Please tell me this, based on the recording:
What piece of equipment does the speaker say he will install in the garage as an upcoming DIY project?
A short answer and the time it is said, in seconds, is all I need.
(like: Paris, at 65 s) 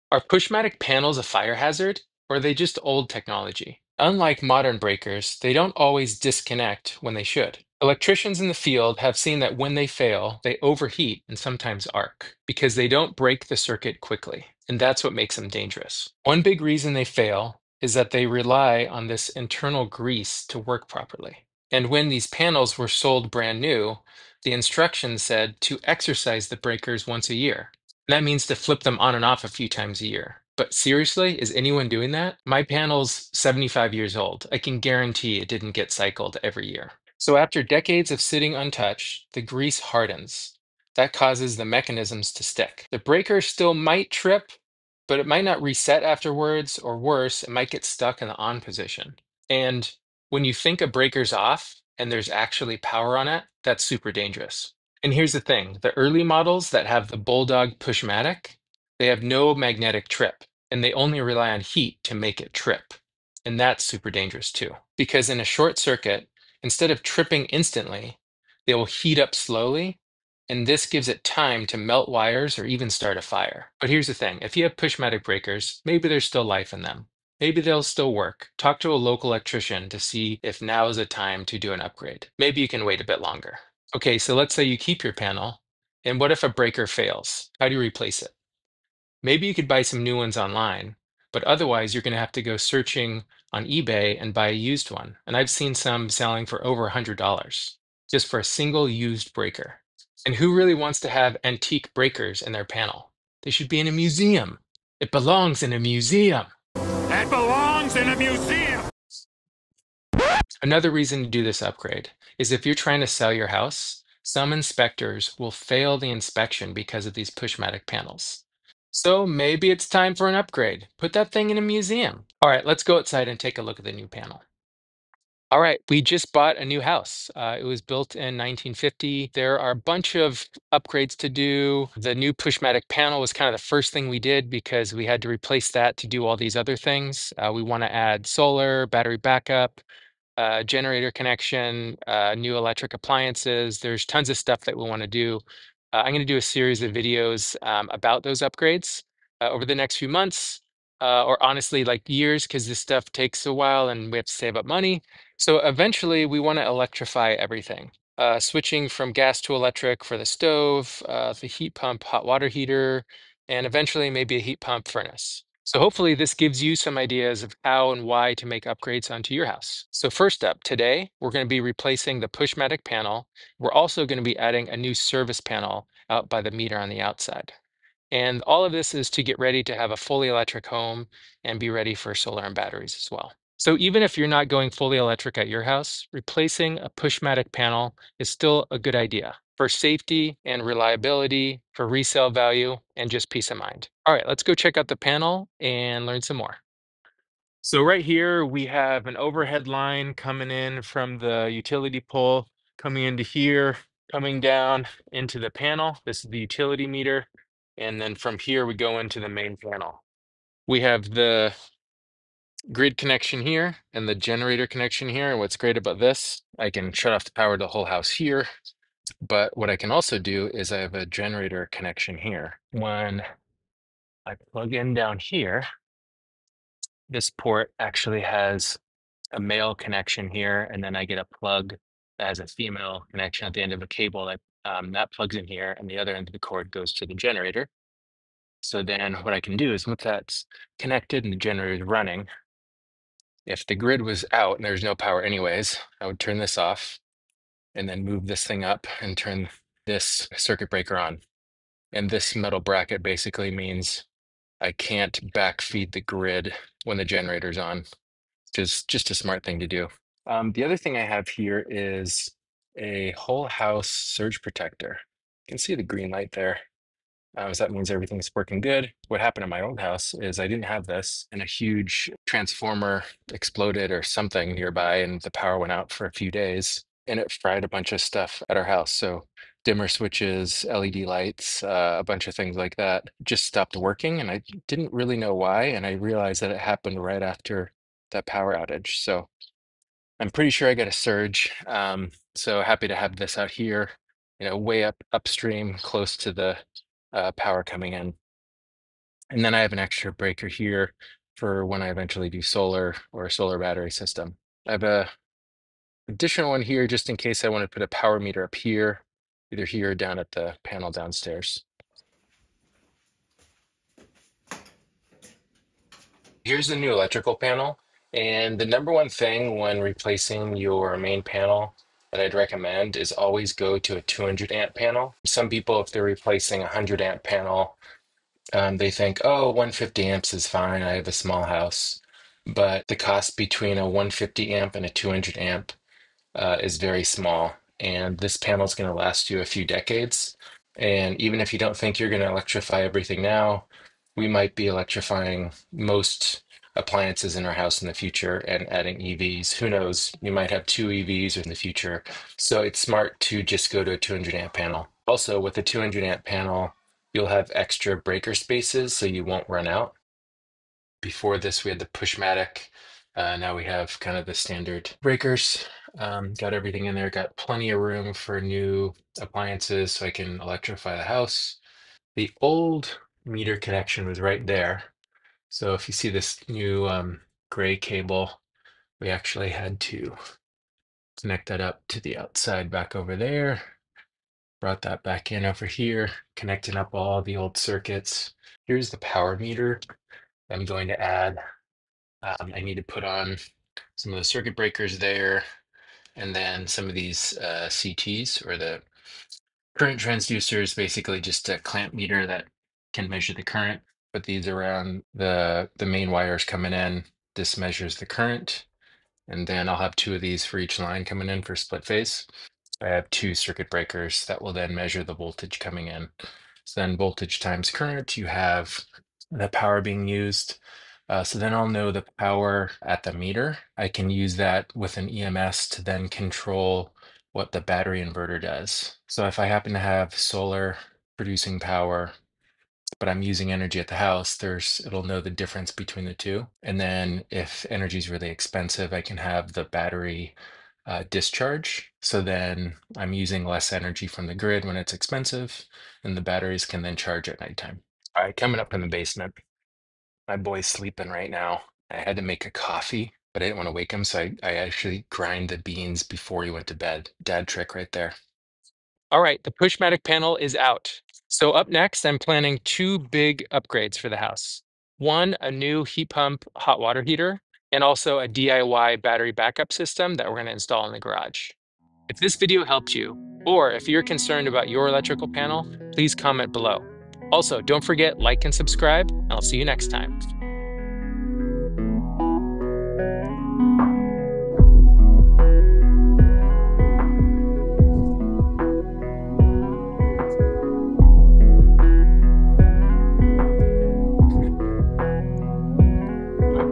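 Battery backup system, at 469 s.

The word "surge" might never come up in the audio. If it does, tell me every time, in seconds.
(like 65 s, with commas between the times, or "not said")
263 s, 290 s.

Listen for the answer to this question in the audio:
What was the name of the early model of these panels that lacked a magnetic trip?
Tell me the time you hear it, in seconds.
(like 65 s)
57 s.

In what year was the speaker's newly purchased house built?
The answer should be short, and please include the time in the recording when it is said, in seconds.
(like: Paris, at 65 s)
1950, at 128 s.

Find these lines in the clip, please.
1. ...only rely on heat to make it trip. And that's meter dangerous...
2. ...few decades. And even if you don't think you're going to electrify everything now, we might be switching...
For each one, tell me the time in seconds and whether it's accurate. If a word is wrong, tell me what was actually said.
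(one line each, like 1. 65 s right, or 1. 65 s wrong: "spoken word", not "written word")
1. 60 s wrong: "super", not "meter"
2. 339 s wrong: "electrifying", not "switching".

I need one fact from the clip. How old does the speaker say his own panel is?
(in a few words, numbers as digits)
75 years.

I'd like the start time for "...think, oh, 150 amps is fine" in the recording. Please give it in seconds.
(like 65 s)
328 s.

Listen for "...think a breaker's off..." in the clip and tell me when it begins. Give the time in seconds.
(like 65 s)
50 s.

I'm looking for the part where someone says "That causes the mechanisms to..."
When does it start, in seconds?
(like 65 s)
40 s.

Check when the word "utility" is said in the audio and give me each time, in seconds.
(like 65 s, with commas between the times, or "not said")
201 s, 206 s.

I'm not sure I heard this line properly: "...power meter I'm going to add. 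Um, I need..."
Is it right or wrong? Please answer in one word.
right.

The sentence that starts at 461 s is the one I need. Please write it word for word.
So up next, I'm planning two big upgrades for the house.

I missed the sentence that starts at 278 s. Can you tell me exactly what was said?
So dimmer switches, LED lights, uh, a bunch of things like that just stopped working.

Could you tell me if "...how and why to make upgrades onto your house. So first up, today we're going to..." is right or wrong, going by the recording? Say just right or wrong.
right.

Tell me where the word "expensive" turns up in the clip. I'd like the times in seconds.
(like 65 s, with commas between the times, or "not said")
438 s, 444 s.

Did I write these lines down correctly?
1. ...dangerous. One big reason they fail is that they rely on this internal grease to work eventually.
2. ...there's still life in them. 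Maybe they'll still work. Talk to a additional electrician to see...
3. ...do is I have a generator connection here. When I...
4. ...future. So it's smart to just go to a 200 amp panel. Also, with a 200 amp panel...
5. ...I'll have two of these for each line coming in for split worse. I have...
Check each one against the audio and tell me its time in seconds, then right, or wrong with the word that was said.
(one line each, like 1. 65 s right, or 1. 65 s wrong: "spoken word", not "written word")
1. 15 s wrong: "properly", not "eventually"
2. 76 s wrong: "local", not "additional"
3. 220 s right
4. 351 s right
5. 409 s wrong: "phase", not "worse".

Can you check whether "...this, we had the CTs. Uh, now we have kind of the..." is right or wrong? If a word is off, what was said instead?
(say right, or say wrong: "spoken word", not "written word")
wrong: "Pushmatic", not "CTs".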